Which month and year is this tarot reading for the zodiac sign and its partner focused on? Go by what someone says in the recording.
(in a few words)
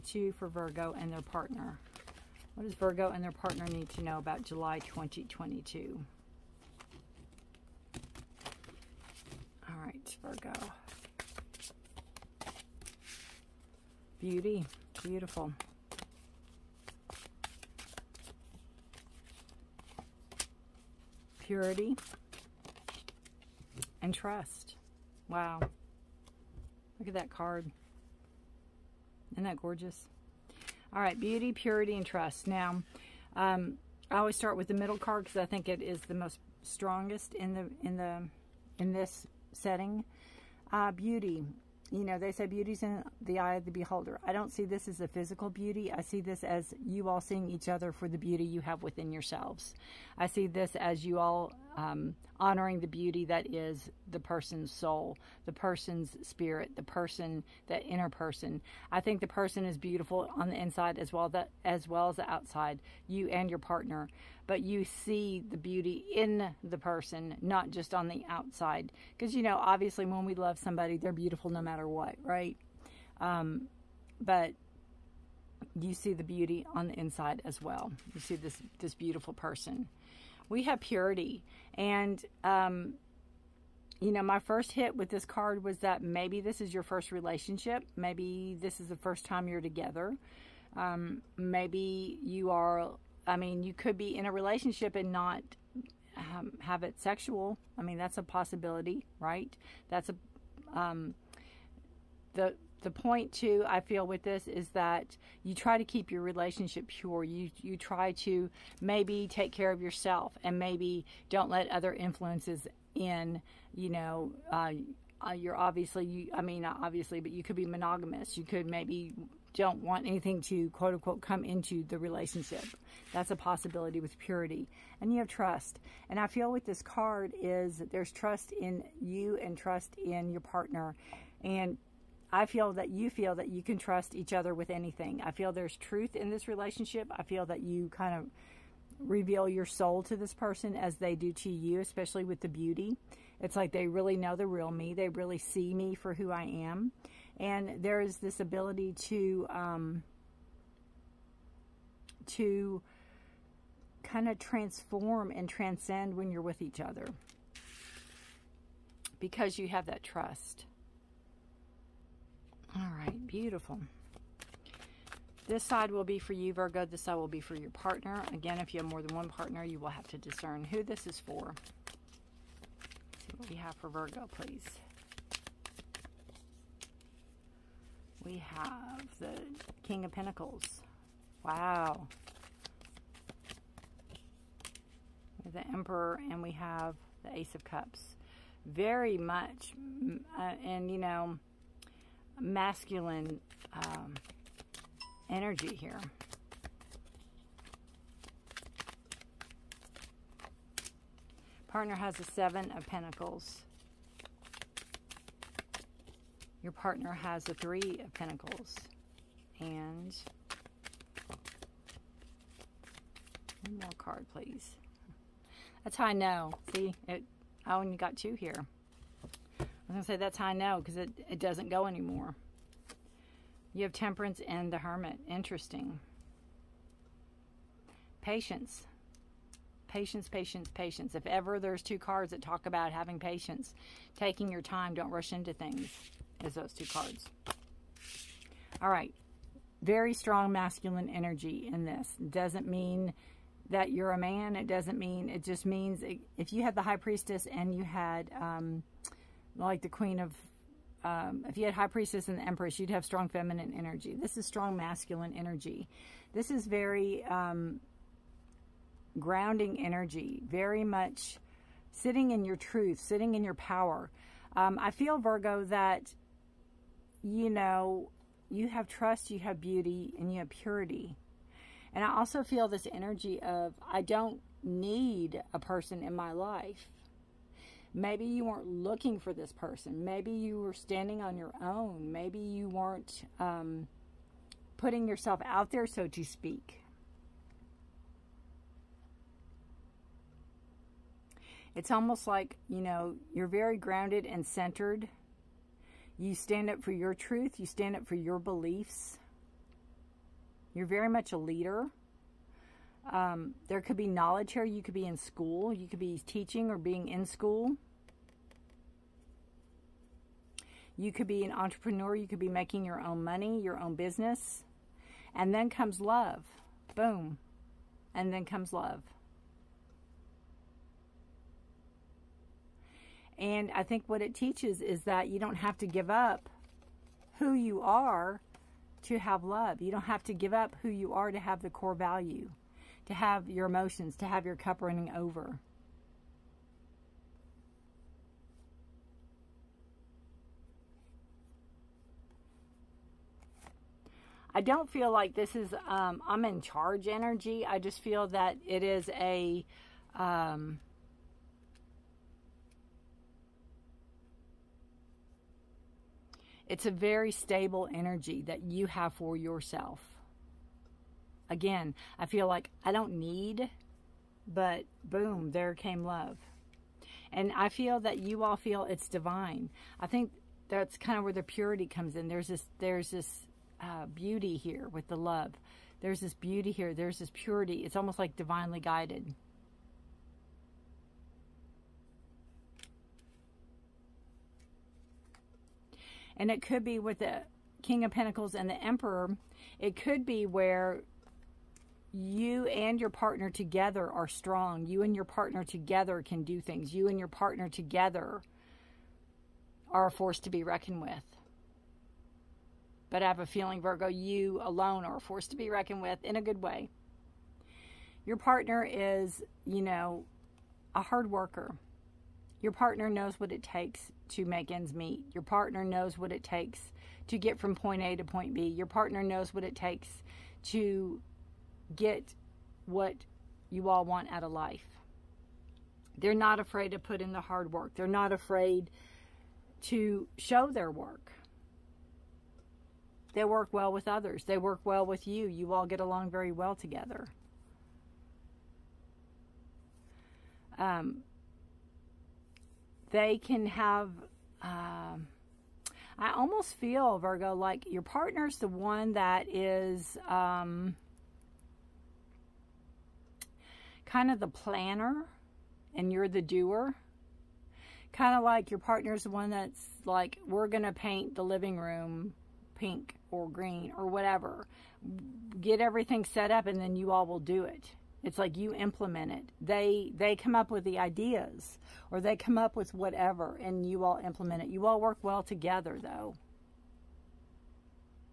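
July 2022.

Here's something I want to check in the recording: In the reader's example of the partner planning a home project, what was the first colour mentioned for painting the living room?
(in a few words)
Pink.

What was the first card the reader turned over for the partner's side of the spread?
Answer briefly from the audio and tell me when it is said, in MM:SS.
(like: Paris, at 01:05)
Seven of Pentacles, at 03:22.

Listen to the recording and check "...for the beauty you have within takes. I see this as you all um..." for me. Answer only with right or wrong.
wrong.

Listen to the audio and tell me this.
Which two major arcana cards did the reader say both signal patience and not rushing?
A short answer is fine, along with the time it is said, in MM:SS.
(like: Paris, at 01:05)
Temperance and the Hermit, at 03:43.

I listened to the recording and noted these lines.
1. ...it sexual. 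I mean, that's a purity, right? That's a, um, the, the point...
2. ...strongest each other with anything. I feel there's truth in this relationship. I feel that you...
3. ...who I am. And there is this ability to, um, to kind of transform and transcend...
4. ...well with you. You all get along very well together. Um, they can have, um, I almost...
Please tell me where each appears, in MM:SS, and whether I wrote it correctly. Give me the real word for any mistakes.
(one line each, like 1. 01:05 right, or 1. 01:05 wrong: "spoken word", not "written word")
1. 01:36 wrong: "possibility", not "purity"
2. 02:13 wrong: "trust", not "strongest"
3. 02:26 right
4. 07:14 right.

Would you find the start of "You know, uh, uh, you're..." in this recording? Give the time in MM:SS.
01:53.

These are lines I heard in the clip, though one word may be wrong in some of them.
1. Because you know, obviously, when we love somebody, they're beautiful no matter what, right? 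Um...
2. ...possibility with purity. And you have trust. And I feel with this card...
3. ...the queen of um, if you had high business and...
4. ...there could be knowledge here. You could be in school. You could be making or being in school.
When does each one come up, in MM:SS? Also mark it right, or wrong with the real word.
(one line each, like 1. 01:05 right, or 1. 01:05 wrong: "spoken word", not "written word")
1. 01:09 right
2. 02:03 right
3. 04:09 wrong: "priestess", not "business"
4. 05:03 wrong: "teaching", not "making".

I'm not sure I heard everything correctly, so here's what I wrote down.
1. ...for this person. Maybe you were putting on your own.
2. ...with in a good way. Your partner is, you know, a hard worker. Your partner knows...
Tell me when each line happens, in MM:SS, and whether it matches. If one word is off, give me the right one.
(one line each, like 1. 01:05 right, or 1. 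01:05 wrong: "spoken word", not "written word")
1. 04:39 wrong: "standing", not "putting"
2. 06:46 right.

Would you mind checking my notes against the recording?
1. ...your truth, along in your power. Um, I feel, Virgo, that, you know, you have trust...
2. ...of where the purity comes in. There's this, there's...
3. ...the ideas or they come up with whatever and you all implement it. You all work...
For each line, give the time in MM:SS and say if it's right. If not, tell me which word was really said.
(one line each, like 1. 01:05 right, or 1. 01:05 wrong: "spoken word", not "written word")
1. 04:22 wrong: "sitting", not "along"
2. 06:11 right
3. 07:50 right.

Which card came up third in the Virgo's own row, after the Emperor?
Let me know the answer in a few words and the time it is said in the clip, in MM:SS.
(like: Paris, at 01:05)
Ace of Cups, at 03:07.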